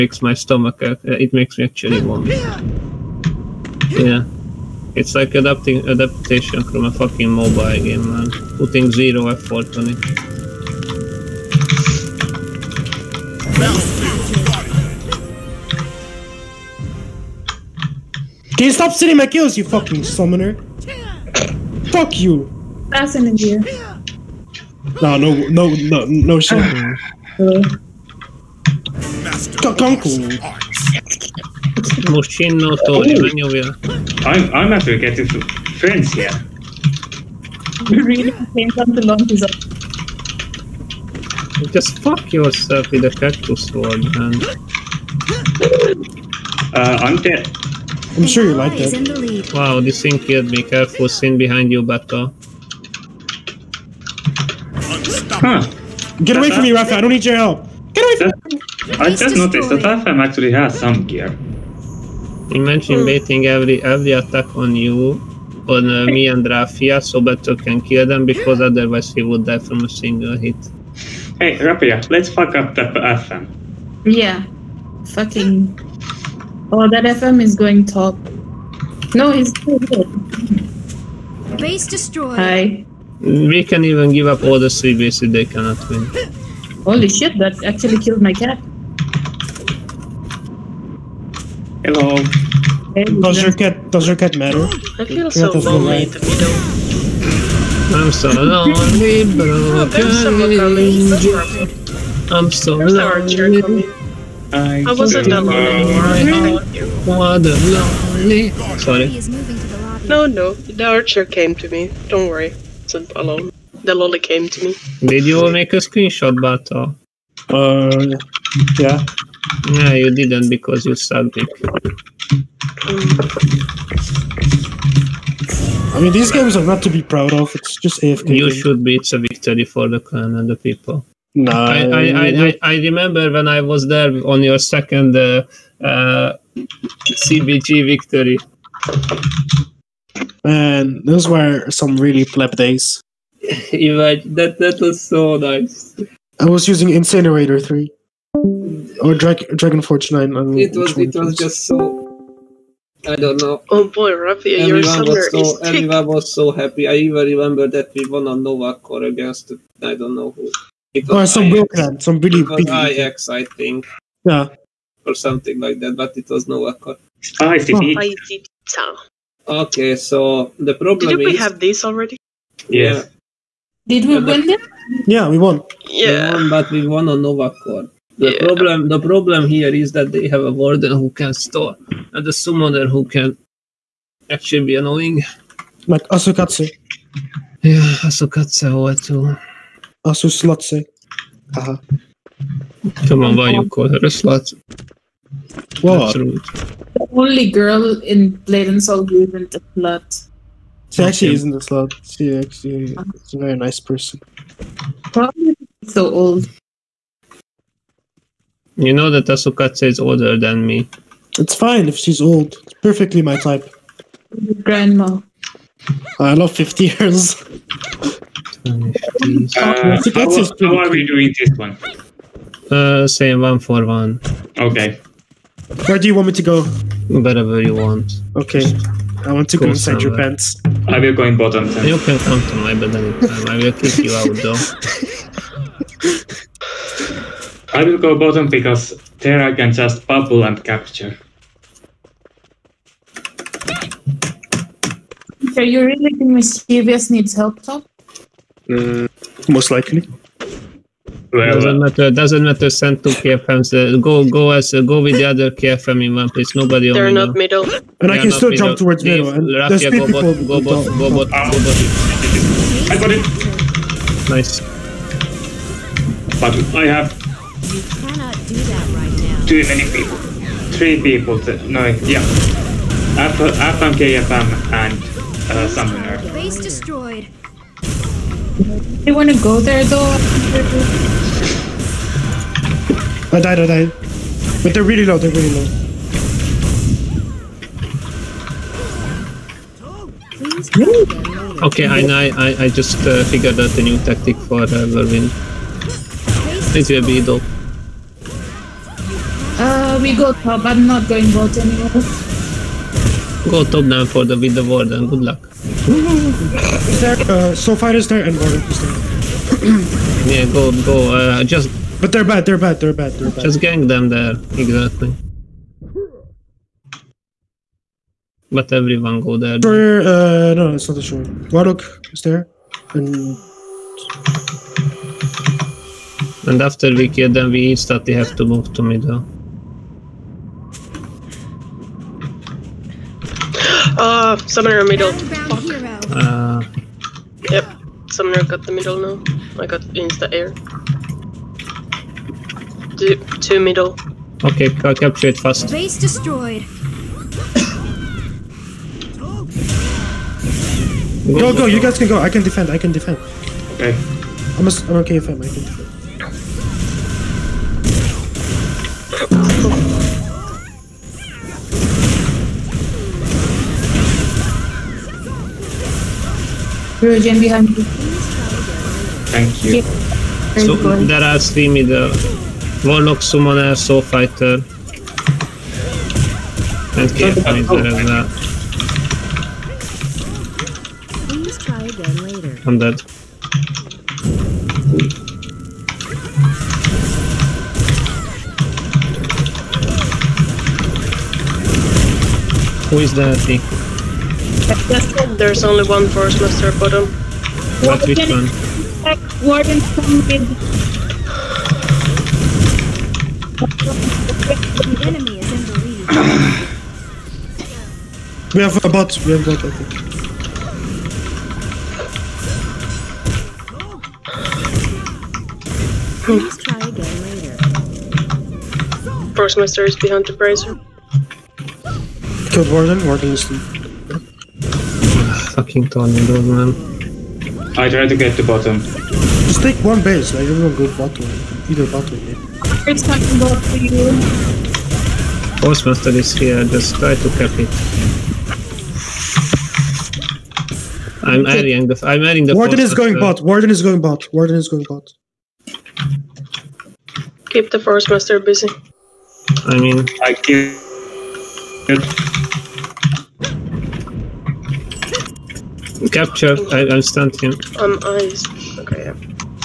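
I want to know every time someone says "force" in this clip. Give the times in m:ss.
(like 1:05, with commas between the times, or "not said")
6:36, 6:59, 7:15, 7:27.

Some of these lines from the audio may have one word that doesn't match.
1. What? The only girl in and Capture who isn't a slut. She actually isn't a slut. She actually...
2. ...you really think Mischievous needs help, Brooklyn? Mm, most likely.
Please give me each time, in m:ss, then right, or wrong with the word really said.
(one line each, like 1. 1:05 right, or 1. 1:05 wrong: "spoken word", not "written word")
1. 3:15 wrong: "Soul", not "Capture"
2. 4:05 wrong: "Top", not "Brooklyn".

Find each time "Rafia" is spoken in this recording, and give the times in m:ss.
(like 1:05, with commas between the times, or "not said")
1:06, 4:19.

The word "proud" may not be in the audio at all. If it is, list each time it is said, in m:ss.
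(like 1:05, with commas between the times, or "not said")
2:07.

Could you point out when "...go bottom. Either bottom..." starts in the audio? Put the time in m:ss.
7:10.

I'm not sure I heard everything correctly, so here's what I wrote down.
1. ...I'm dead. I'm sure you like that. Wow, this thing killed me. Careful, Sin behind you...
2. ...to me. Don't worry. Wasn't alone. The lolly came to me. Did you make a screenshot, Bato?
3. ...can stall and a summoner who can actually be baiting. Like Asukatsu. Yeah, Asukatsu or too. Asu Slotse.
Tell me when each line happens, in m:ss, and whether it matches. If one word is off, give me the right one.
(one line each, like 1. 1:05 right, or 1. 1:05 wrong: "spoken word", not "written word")
1. 0:47 right
2. 1:51 right
3. 3:01 wrong: "annoying", not "baiting".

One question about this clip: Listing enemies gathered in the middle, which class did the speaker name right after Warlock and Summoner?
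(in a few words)
Soul Fighter.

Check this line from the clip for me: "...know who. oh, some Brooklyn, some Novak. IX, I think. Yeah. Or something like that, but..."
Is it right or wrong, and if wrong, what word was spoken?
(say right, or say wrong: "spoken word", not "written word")
wrong: "Billy", not "Novak".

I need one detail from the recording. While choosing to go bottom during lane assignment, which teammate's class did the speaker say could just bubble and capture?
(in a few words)
Terra.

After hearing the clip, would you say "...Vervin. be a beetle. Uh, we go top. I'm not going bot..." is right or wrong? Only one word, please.
right.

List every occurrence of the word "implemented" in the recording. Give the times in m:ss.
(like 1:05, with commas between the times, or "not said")
not said.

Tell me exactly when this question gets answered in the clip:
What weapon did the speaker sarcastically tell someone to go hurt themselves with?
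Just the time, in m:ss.
0:43.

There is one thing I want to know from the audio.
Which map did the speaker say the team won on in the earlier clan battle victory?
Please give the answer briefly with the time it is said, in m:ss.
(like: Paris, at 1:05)
Novak Core, at 2:57.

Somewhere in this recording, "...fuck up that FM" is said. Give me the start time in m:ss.
1:12.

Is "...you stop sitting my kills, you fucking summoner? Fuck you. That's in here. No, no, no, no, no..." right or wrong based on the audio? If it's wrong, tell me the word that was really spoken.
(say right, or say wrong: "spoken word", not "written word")
right.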